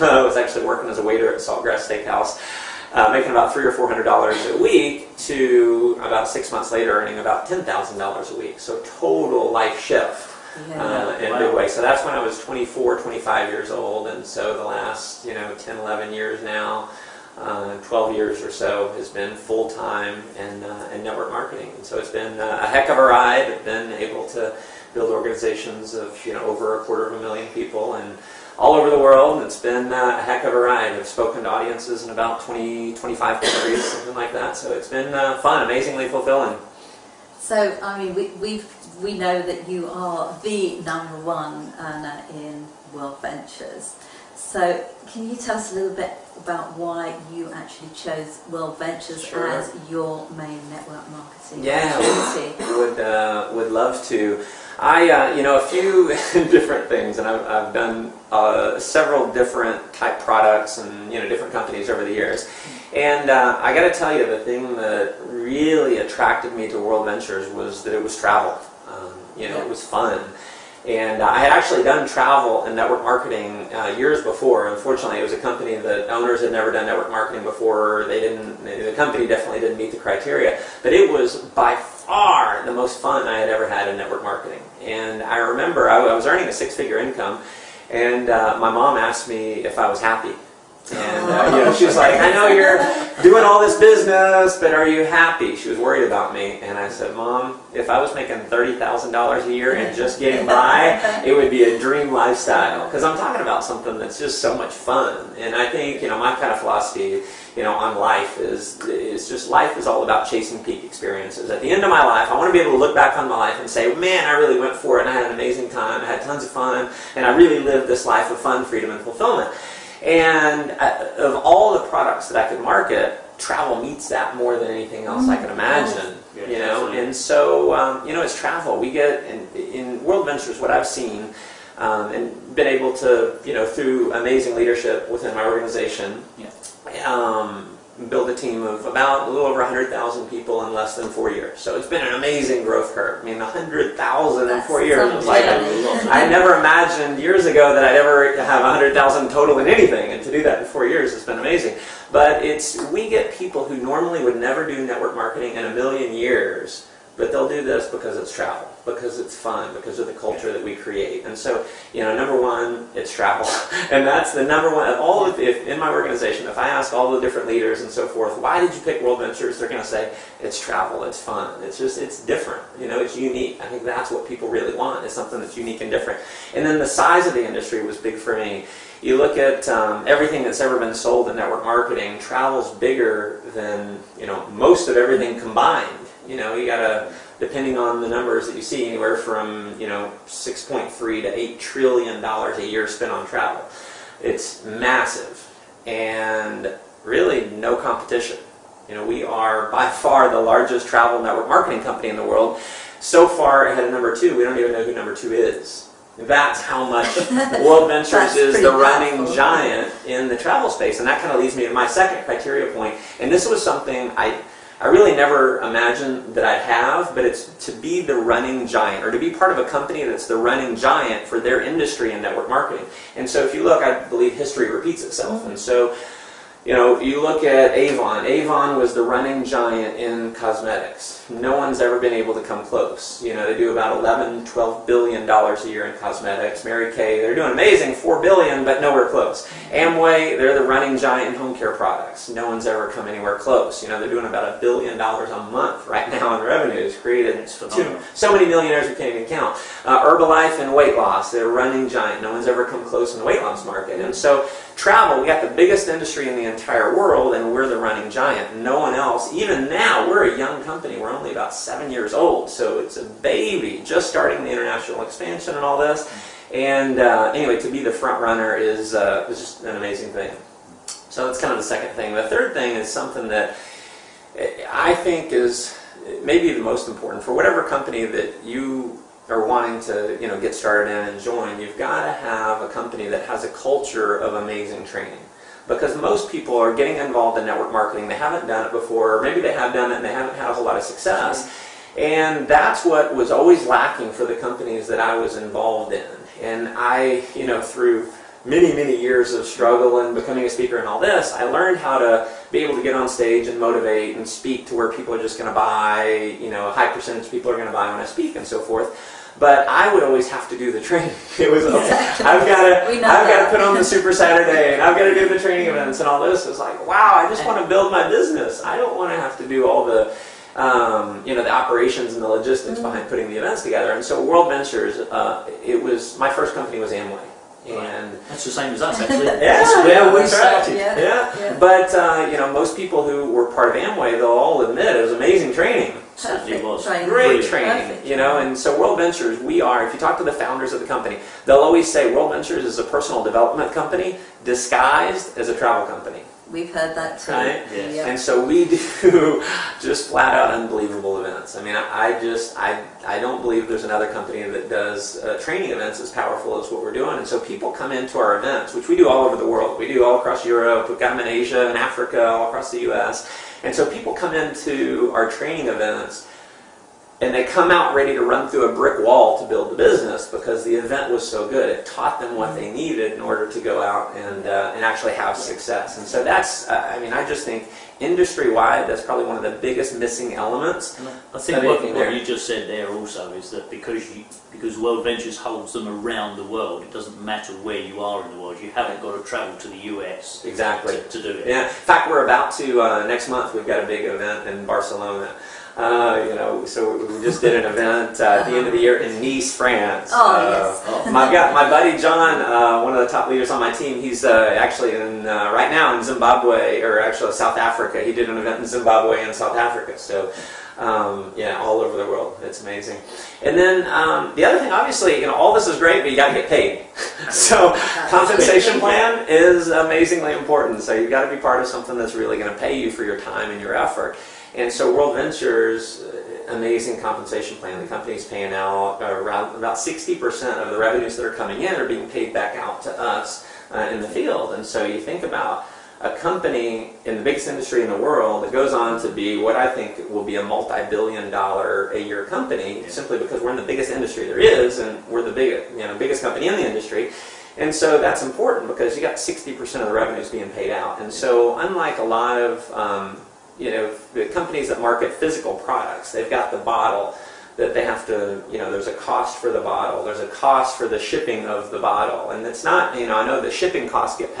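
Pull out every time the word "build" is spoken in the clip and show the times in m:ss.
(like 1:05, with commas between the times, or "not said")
0:24, 2:18, 5:17, 6:09.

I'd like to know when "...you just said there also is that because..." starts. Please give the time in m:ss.
6:22.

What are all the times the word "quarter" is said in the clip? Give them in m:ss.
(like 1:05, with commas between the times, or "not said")
0:26.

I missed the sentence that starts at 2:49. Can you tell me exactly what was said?
They're going to say, it's travel, it's fun, it's just, it's different.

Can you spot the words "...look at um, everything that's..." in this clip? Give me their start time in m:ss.
2:59.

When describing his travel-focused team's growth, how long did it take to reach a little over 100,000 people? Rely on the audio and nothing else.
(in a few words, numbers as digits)
Less than 4 years.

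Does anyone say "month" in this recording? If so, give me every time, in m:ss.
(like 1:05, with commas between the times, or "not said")
0:06, 4:05, 6:33.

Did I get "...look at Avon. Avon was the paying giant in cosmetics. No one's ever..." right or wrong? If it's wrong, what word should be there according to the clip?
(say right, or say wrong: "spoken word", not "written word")
wrong: "running", not "paying".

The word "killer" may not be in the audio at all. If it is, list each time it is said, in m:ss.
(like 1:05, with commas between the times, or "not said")
not said.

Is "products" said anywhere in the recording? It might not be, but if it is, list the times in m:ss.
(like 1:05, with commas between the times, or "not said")
1:00, 2:01, 4:01, 7:35.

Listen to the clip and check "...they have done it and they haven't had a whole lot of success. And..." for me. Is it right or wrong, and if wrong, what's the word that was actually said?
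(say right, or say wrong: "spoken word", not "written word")
right.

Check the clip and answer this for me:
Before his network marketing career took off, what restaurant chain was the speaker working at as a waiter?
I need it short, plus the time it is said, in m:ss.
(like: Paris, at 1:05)
Saltgrass Steakhouse, at 0:01.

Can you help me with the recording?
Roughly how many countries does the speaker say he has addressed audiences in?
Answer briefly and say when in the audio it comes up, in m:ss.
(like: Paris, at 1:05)
20, 25, at 0:32.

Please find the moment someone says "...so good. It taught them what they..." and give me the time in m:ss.
6:11.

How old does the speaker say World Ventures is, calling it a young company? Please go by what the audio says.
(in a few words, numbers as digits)
About 7 years.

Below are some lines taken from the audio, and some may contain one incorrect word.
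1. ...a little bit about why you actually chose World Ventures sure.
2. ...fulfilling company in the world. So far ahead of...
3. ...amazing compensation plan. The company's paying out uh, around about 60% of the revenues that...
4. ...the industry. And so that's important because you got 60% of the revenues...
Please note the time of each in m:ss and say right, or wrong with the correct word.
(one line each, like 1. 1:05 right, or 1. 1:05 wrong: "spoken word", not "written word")
1. 0:45 right
2. 3:21 wrong: "marketing", not "fulfilling"
3. 7:06 right
4. 7:26 right.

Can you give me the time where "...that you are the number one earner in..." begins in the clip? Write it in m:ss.
0:39.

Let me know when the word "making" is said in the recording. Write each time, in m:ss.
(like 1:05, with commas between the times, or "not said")
0:03, 1:38.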